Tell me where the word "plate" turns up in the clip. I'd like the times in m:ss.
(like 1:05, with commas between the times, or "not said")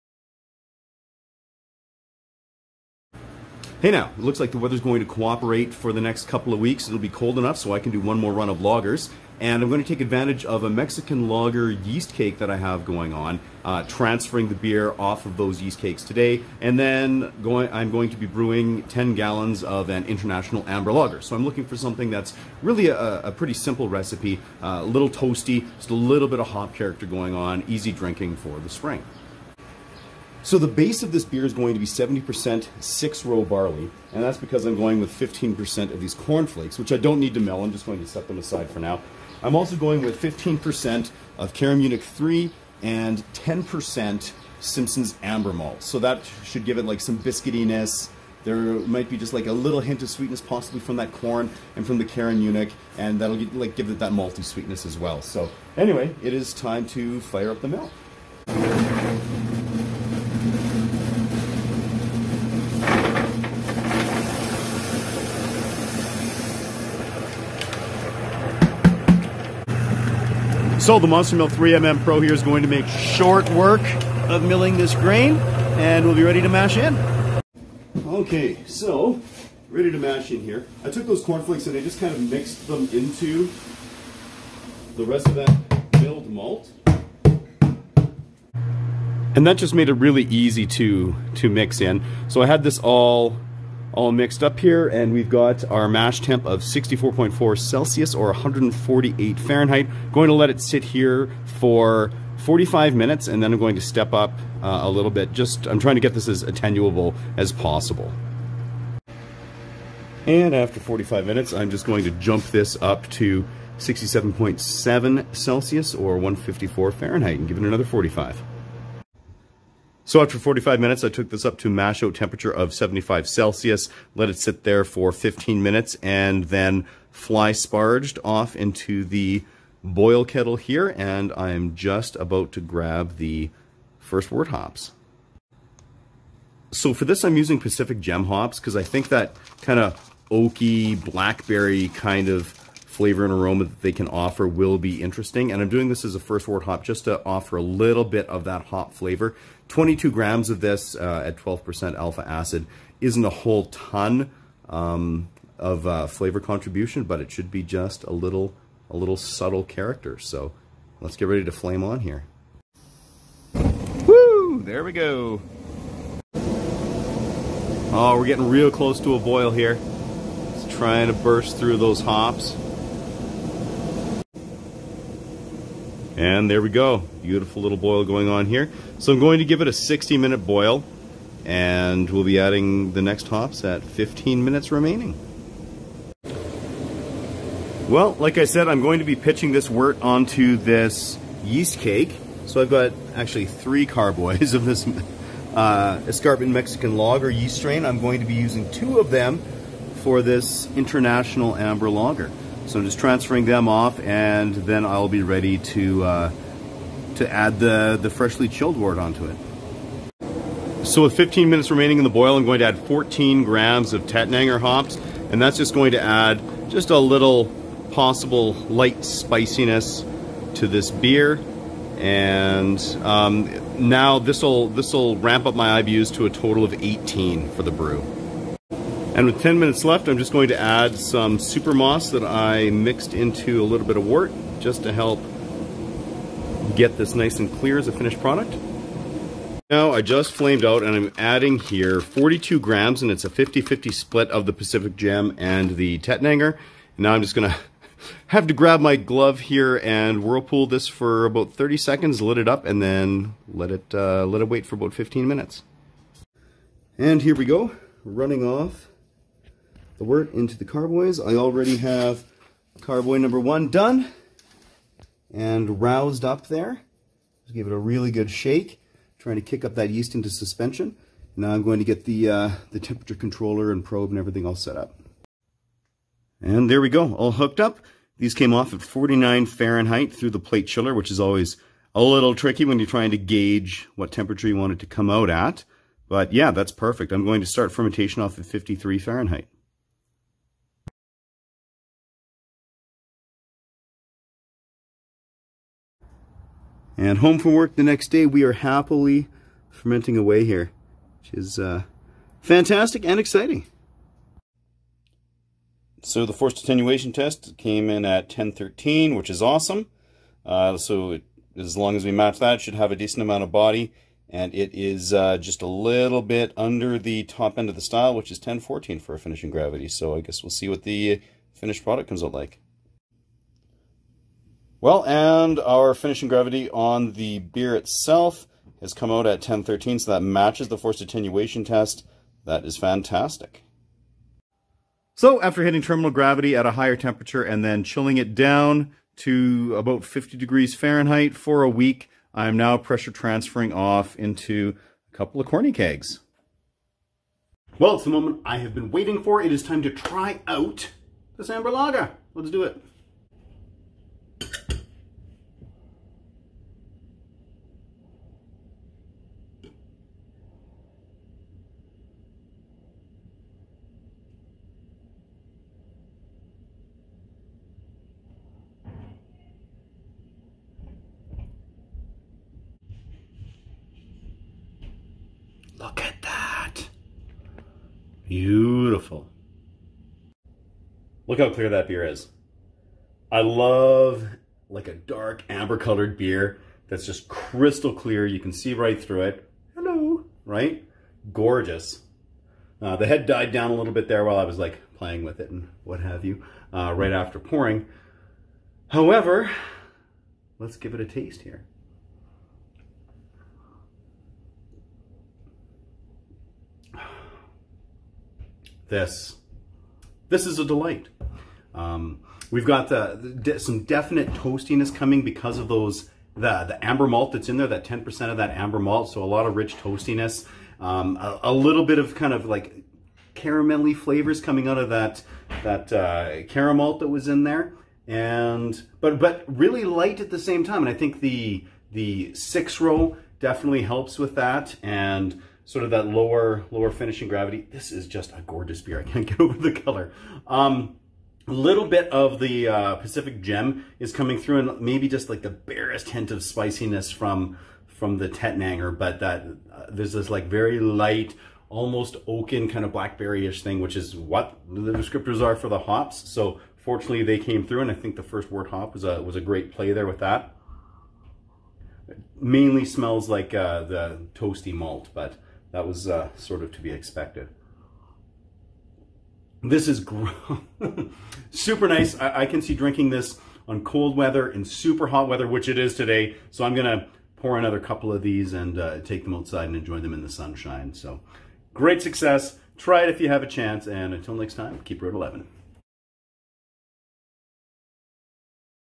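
4:40.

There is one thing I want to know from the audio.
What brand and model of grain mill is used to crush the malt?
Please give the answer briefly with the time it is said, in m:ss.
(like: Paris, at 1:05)
Monster Mill 3mm Pro, at 1:11.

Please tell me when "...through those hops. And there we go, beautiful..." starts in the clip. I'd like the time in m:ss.
2:51.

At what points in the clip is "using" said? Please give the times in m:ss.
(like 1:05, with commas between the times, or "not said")
2:17, 3:18.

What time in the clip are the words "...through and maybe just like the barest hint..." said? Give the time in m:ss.
7:24.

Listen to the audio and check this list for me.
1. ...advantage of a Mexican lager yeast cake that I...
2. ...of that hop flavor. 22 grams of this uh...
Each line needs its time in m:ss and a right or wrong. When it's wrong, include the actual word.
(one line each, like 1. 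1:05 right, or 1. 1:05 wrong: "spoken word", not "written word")
1. 0:10 right
2. 2:28 right.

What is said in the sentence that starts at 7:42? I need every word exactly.
It mainly smells like uh, the toasty malt, but that was uh, sort of to be expected.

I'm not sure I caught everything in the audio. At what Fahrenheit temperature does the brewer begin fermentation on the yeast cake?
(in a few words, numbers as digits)
53 Fahrenheit.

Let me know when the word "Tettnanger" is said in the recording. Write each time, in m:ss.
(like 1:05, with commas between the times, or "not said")
3:34, 4:05, 7:28.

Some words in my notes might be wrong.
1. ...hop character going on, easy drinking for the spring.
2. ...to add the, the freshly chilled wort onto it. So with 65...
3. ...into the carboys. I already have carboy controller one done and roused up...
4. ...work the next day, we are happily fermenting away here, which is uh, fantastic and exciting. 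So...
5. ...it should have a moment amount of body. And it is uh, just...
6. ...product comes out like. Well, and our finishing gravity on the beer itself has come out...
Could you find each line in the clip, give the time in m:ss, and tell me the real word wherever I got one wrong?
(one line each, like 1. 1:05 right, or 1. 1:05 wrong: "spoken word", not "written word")
1. 0:26 right
2. 3:27 wrong: "15", not "65"
3. 4:20 wrong: "number", not "controller"
4. 4:57 right
5. 5:12 wrong: "decent", not "moment"
6. 5:21 right.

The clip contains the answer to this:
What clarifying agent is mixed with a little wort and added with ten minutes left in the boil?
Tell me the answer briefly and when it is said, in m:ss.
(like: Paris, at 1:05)
Super moss, at 3:51.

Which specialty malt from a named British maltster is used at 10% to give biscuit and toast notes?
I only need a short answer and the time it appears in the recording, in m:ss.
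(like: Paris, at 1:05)
Simpson's Amber Malt, at 0:44.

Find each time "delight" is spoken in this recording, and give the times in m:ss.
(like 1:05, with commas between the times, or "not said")
6:50.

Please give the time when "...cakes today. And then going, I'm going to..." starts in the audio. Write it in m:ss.
0:15.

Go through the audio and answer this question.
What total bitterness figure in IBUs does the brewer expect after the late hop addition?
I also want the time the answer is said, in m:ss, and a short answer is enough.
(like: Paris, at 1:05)
18, at 3:46.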